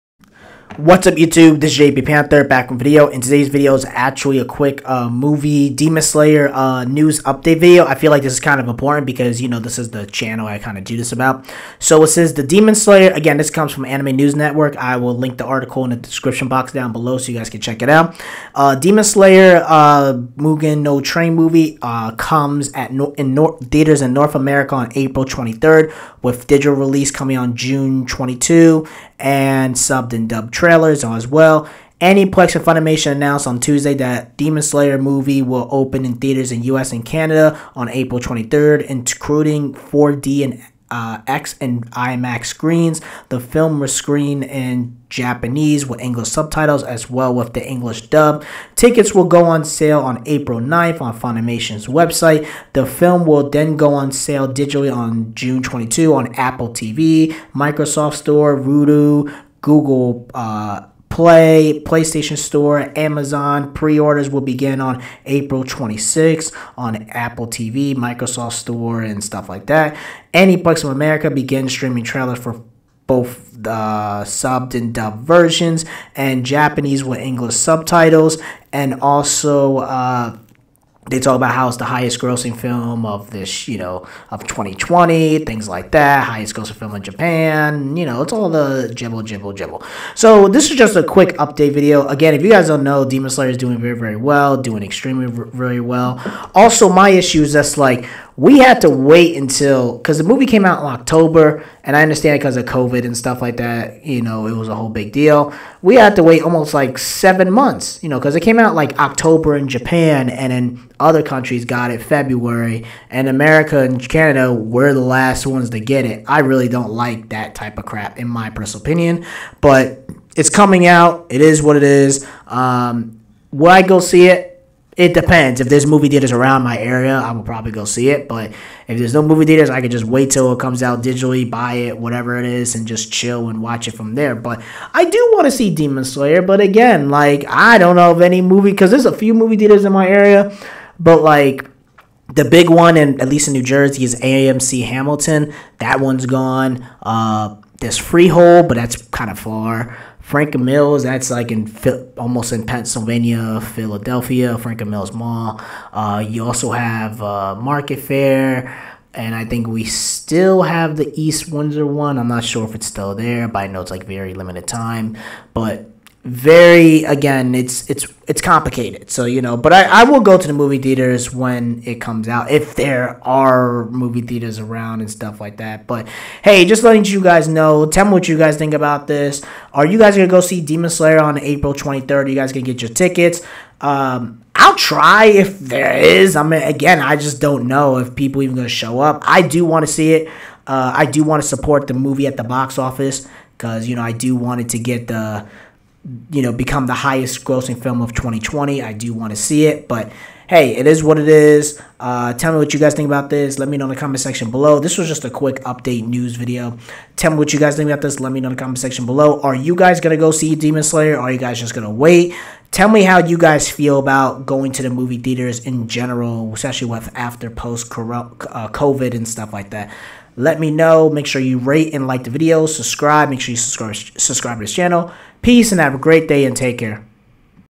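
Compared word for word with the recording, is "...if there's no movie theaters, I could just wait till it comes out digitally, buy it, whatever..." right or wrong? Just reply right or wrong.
right.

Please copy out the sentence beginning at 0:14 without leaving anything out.
I will link the article in the description box down below so you guys can check it out.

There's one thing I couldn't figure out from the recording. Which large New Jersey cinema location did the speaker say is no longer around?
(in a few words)
AMC Hamilton.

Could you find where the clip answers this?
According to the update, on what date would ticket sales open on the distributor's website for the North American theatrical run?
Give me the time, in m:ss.
0:50.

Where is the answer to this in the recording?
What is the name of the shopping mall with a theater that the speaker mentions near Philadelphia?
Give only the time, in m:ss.
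2:34.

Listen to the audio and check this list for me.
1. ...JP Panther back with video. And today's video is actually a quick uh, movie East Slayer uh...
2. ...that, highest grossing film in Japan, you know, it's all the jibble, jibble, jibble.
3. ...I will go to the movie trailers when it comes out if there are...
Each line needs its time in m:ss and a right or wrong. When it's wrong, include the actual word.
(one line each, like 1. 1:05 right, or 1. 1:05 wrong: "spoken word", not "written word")
1. 0:01 wrong: "Demon", not "East"
2. 1:25 right
3. 2:50 wrong: "theaters", not "trailers".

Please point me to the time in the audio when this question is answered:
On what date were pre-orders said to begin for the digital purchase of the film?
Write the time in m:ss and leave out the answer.
1:05.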